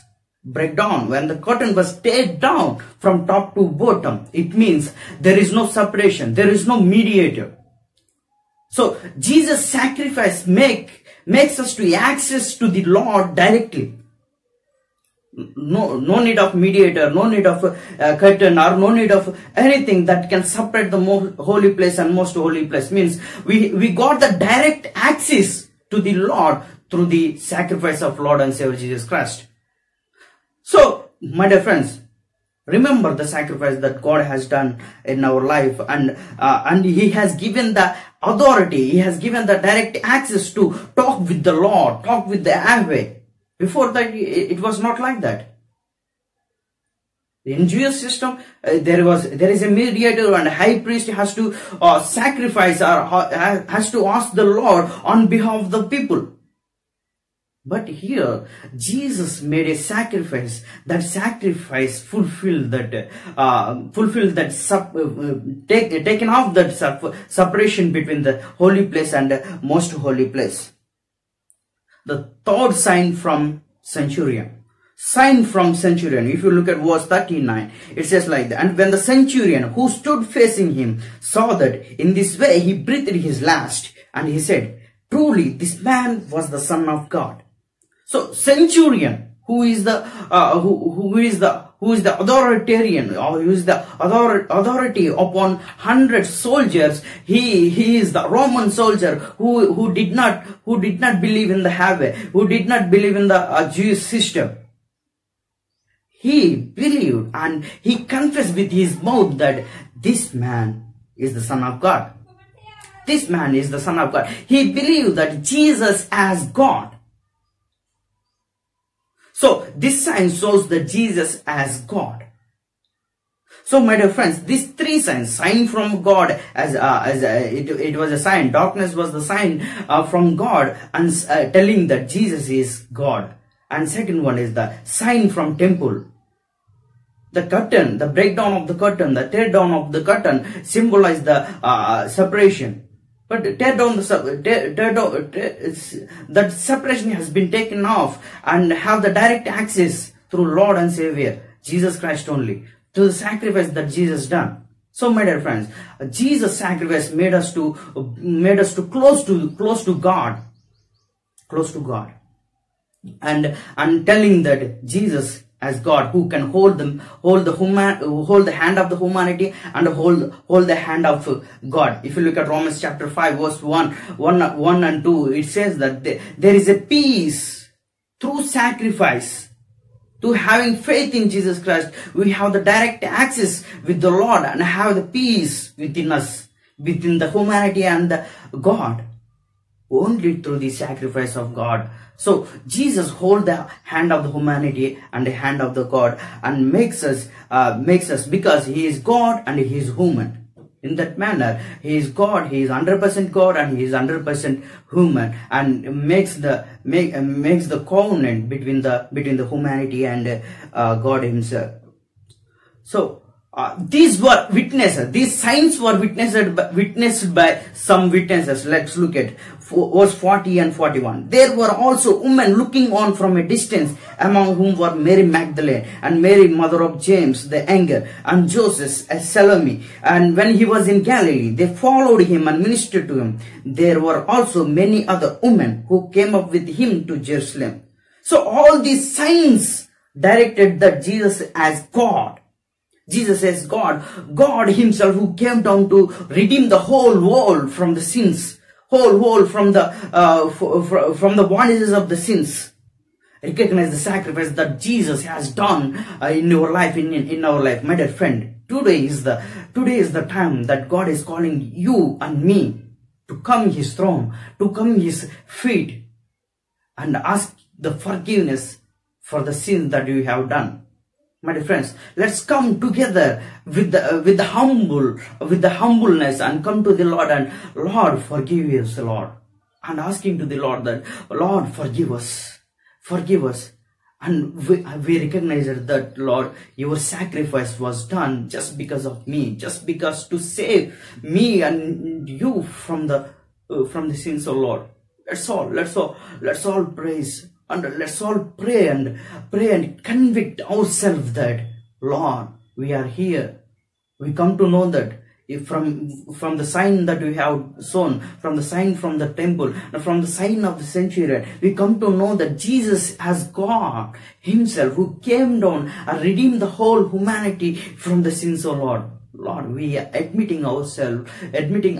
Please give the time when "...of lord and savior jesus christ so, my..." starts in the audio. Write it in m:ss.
0:28.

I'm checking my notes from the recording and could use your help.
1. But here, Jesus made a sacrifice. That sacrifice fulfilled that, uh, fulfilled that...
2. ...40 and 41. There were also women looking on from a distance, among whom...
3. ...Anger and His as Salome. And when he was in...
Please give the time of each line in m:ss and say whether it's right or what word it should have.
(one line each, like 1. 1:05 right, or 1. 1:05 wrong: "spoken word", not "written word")
1. 0:57 right
2. 3:40 right
3. 3:47 wrong: "Joseph", not "His".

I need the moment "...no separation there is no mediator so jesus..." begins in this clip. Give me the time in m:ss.
0:05.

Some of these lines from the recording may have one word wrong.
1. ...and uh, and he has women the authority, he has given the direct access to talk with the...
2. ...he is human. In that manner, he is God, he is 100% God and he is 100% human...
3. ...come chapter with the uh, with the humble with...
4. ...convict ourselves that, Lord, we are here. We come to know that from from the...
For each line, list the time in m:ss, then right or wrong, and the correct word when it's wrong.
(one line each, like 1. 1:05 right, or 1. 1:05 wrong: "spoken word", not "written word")
1. 0:35 wrong: "given", not "women"
2. 3:19 right
3. 4:32 wrong: "together", not "chapter"
4. 5:00 right.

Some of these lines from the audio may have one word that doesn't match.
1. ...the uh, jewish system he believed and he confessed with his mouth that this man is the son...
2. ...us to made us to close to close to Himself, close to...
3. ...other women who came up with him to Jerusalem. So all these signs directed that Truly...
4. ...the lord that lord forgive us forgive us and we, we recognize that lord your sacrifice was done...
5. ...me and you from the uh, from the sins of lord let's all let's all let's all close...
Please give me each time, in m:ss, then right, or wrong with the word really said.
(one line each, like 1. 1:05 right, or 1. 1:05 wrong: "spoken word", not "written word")
1. 1:43 right
2. 2:37 wrong: "God", not "Himself"
3. 3:55 wrong: "Jesus", not "Truly"
4. 4:40 right
5. 4:51 wrong: "praise", not "close".